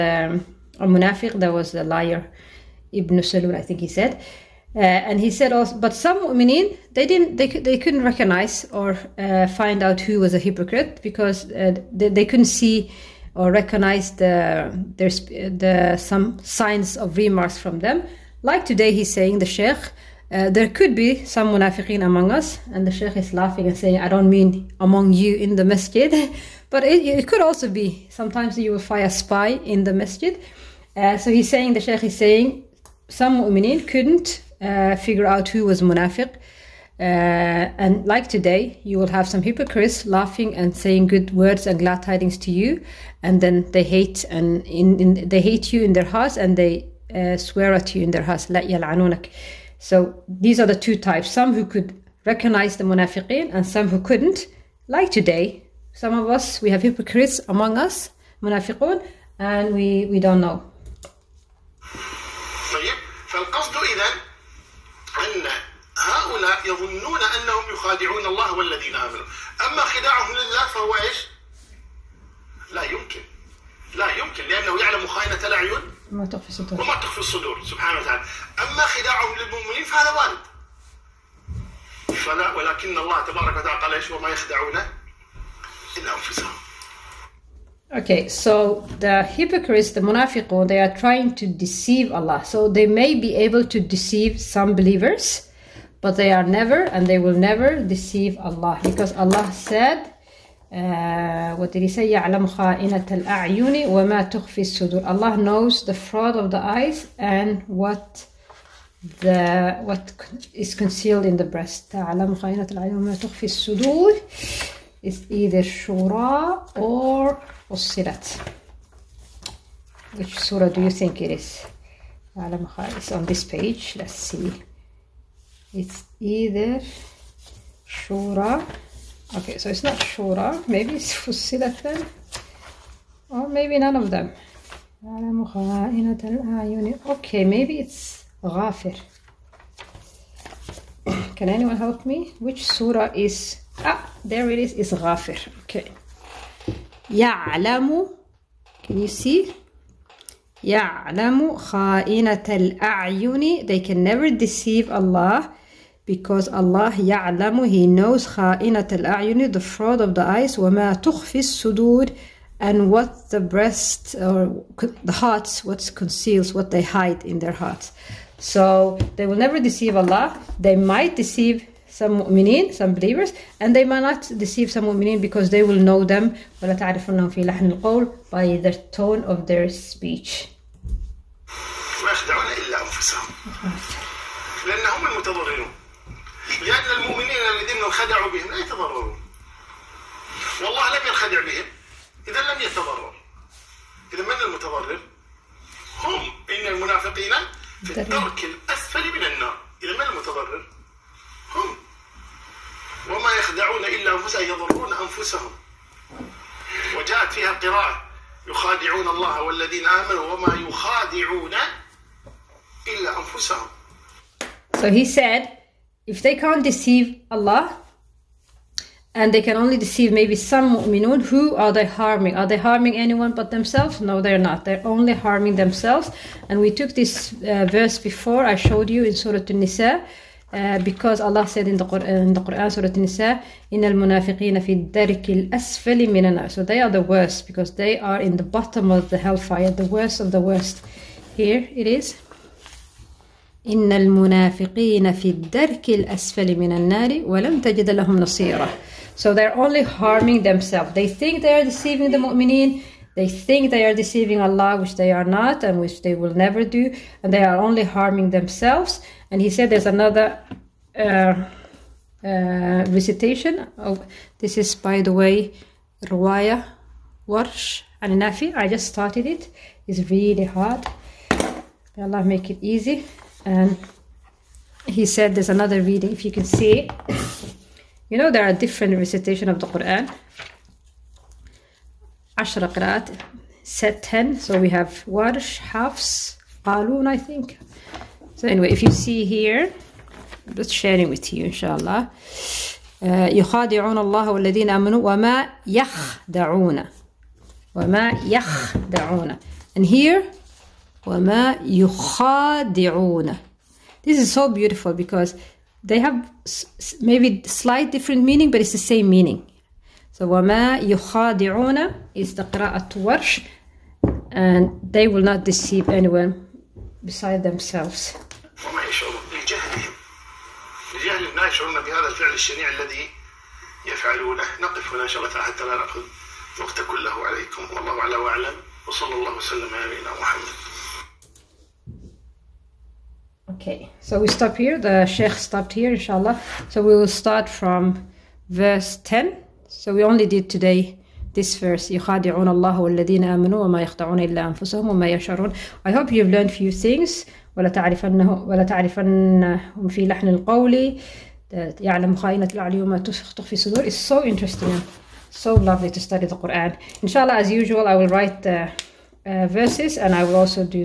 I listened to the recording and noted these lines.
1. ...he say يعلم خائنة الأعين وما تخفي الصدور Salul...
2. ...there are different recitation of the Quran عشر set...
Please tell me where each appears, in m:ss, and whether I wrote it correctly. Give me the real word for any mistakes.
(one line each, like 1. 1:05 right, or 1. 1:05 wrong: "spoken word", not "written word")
1. 1:41 wrong: "Allah", not "Salul"
2. 4:38 right.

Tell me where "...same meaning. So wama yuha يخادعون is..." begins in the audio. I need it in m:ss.
5:08.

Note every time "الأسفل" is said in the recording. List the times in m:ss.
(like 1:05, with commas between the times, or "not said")
3:18, 3:55, 4:05.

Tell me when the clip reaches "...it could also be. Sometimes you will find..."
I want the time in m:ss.
0:27.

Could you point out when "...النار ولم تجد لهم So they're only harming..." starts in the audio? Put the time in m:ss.
4:06.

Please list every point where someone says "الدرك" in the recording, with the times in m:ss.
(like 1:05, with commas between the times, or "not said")
3:18, 3:54, 4:05.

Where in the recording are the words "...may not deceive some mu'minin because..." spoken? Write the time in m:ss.
2:53.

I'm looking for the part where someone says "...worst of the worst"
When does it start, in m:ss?
3:59.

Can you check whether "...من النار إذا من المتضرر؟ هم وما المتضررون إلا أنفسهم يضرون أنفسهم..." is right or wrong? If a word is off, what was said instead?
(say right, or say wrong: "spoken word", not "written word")
wrong: "يخدعون", not "المتضررون".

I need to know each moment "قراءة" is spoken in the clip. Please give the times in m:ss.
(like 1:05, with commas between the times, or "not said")
3:27, 5:12.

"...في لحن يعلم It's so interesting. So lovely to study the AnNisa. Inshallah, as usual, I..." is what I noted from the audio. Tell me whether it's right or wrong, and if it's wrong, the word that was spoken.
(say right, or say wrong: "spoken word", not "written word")
wrong: "Quran", not "AnNisa".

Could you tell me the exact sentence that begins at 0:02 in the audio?
Ibn Salul, I think he said.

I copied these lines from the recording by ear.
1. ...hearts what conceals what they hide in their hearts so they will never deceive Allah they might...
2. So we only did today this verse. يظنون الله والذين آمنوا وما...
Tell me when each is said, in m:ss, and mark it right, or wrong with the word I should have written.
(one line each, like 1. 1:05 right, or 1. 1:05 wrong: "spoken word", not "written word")
1. 2:45 right
2. 5:39 wrong: "يخادعون", not "يظنون".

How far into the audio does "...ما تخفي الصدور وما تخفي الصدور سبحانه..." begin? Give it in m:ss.
1:16.